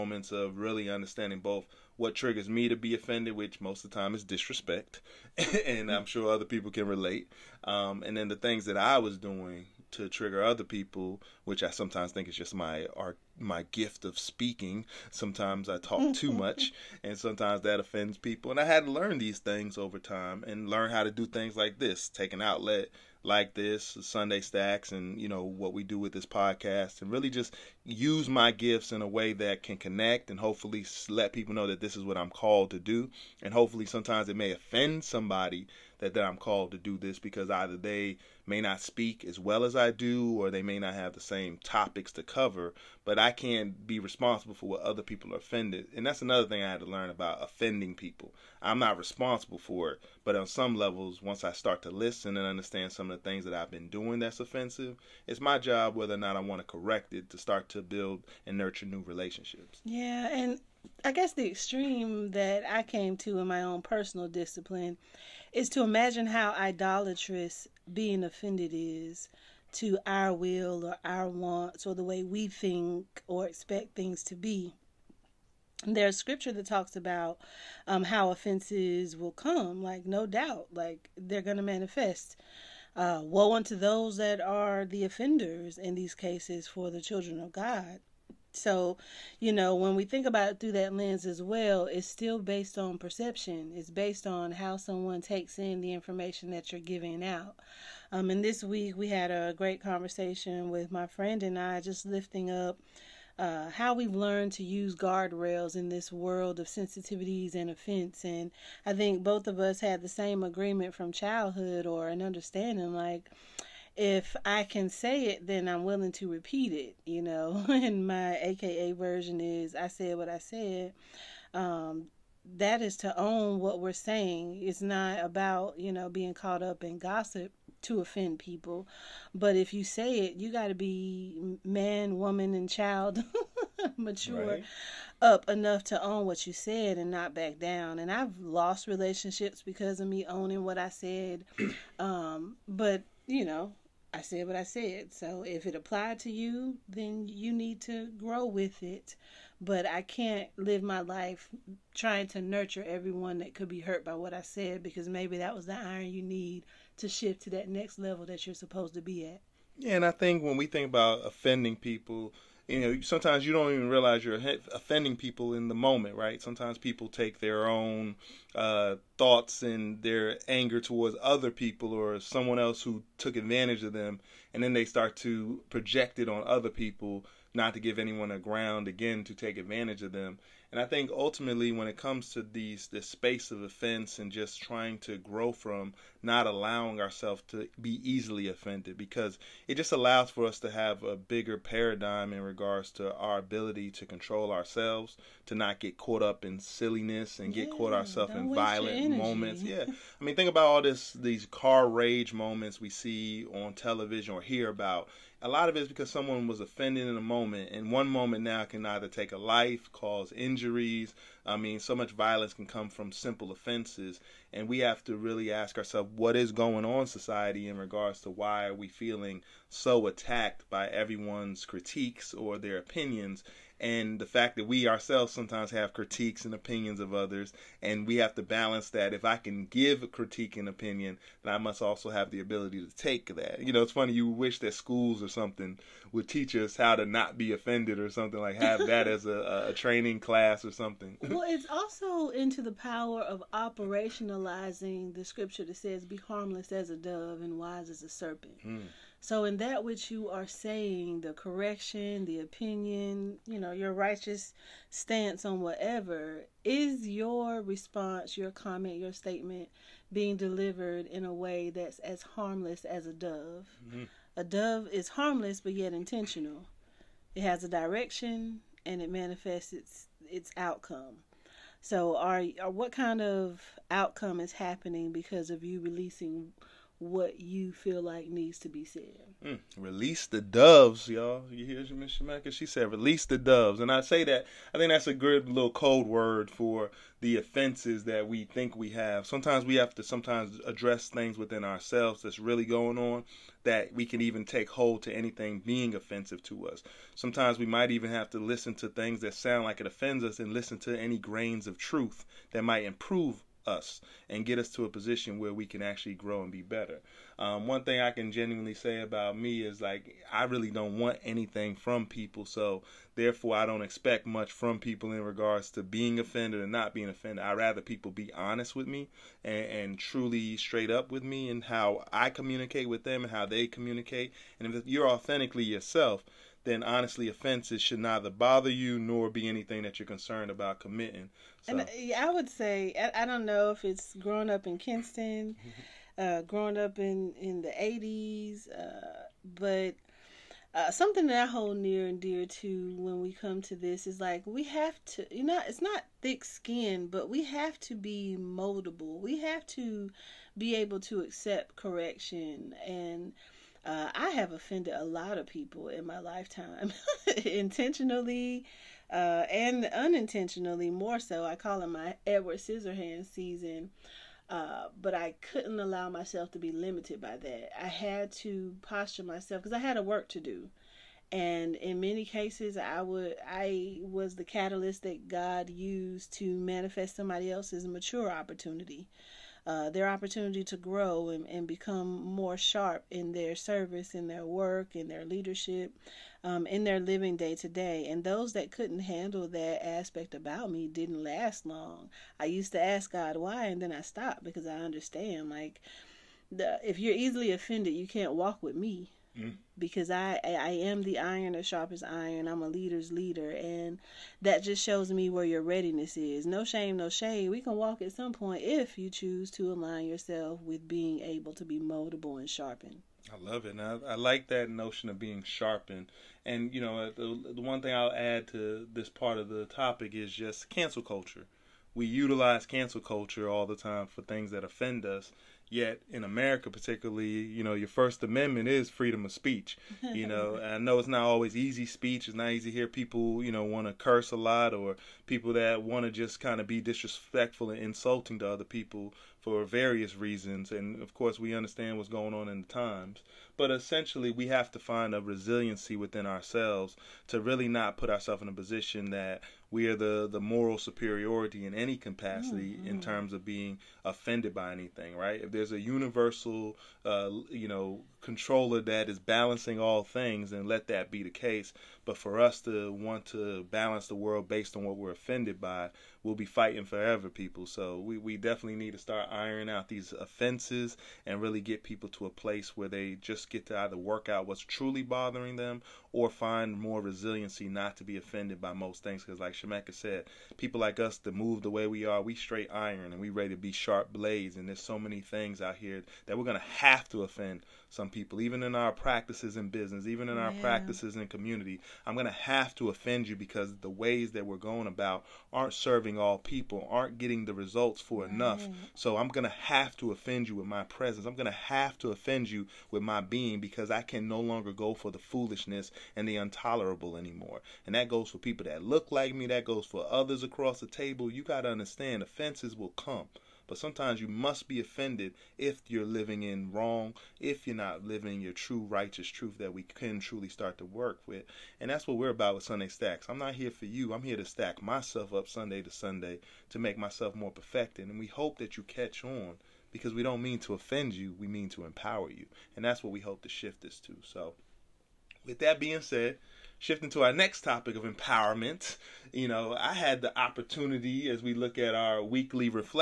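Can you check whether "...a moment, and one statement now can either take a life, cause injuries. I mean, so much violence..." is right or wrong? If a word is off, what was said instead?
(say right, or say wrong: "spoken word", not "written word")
wrong: "moment", not "statement".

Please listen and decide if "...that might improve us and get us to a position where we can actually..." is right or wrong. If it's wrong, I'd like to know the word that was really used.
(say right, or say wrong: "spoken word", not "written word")
right.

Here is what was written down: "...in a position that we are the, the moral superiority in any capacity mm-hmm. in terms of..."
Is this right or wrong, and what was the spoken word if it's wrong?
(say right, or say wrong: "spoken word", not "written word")
right.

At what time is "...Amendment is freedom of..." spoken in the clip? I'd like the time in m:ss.
7:08.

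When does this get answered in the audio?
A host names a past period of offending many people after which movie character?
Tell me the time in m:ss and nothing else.
6:02.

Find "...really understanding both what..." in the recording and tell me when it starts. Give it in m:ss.
0:00.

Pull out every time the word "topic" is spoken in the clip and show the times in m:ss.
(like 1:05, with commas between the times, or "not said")
0:41, 6:59, 8:57.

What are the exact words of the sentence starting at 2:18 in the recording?
And I've lost relationships because of me owning what I said.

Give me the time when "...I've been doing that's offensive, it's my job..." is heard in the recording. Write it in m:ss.
0:53.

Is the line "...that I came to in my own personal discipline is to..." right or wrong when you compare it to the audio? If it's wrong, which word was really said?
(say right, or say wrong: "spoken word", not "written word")
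right.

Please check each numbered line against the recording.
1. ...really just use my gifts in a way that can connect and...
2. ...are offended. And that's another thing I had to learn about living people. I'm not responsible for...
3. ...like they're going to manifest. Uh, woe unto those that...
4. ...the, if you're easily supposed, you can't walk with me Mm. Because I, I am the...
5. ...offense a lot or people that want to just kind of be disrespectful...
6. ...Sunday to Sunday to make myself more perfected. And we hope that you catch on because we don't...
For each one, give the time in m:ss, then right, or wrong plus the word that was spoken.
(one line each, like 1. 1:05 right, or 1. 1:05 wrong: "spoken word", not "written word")
1. 0:27 right
2. 0:45 wrong: "offending", not "living"
3. 1:20 right
4. 6:36 wrong: "offended", not "supposed"
5. 7:13 wrong: "curse", not "offense"
6. 8:45 right.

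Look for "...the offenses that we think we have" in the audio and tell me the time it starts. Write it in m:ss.
4:47.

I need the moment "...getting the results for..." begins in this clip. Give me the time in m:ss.
8:17.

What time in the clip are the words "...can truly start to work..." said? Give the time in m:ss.
8:39.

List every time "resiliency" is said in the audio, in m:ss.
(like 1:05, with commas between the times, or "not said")
7:25, 7:57.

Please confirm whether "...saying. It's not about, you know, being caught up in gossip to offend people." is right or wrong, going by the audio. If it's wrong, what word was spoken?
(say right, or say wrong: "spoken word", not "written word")
right.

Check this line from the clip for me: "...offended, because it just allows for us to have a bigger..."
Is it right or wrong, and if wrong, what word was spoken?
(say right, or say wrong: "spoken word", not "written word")
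right.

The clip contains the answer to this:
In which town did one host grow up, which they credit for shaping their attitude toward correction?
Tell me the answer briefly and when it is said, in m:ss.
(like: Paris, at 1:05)
Kinston, at 5:34.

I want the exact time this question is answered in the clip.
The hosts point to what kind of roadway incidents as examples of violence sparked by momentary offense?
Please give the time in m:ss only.
3:21.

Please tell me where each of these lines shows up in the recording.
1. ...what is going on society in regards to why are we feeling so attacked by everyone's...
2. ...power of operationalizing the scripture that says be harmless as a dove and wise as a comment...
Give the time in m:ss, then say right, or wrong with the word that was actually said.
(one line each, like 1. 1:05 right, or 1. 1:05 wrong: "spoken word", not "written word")
1. 3:36 right
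2. 4:02 wrong: "serpent", not "comment".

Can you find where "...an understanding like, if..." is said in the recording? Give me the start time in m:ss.
1:52.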